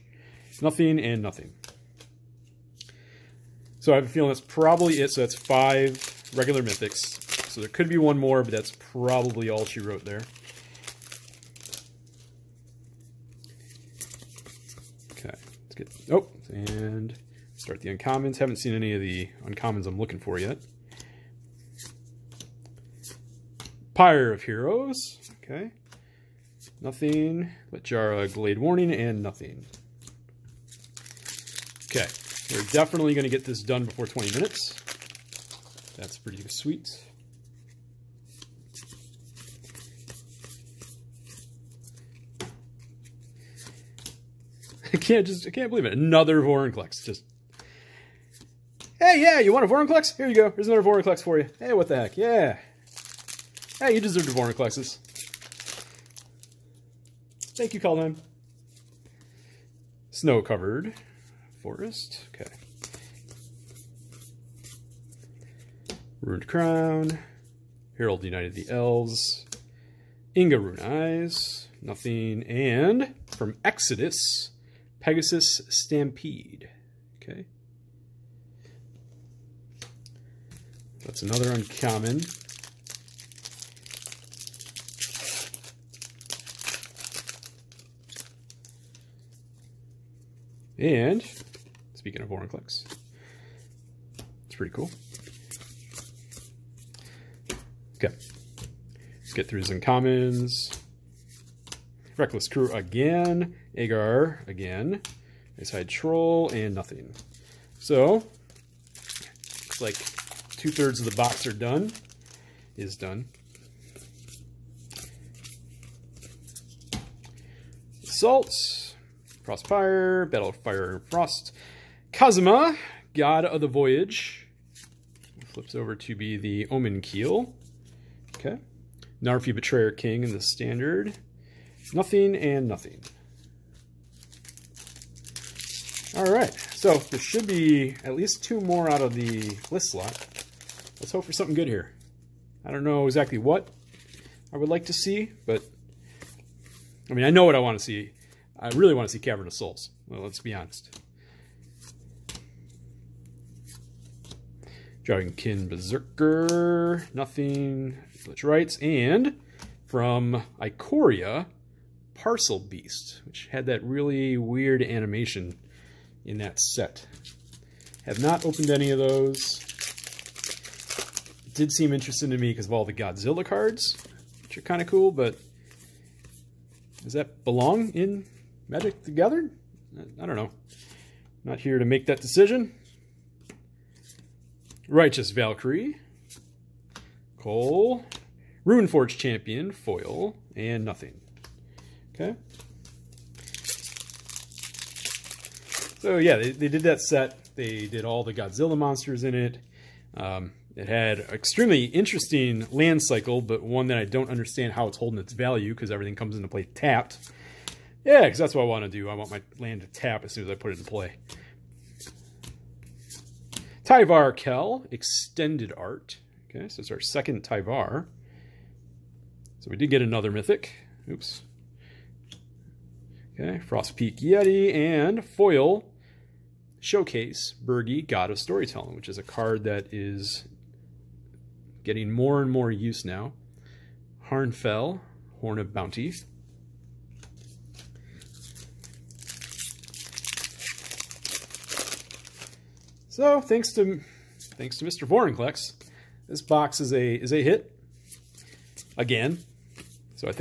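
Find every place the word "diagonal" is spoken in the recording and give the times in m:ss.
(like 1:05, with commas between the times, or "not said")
not said.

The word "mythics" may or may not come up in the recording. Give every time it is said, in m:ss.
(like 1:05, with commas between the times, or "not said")
0:06, 3:40.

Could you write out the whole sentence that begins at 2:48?
Have not opened any of those.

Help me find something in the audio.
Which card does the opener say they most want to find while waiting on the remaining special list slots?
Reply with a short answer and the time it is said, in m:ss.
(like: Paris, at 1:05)
Cavern of Souls, at 2:29.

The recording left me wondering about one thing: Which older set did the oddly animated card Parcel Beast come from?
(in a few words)
Ikoria.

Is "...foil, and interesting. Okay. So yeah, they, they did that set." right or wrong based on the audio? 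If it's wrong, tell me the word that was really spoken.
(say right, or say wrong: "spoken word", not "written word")
wrong: "nothing", not "interesting".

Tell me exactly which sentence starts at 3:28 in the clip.
Yeah, because that's what I want to do.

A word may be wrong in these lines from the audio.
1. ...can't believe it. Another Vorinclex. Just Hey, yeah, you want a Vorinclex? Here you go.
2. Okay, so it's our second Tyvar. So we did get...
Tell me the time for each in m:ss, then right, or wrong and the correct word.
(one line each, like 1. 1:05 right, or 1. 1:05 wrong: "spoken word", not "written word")
1. 0:45 right
2. 3:36 right.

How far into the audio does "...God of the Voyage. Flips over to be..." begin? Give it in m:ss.
2:03.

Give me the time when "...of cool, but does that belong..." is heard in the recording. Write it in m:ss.
2:54.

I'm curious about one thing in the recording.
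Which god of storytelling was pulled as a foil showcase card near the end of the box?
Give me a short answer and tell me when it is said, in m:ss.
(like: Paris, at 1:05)
Birgi, at 3:47.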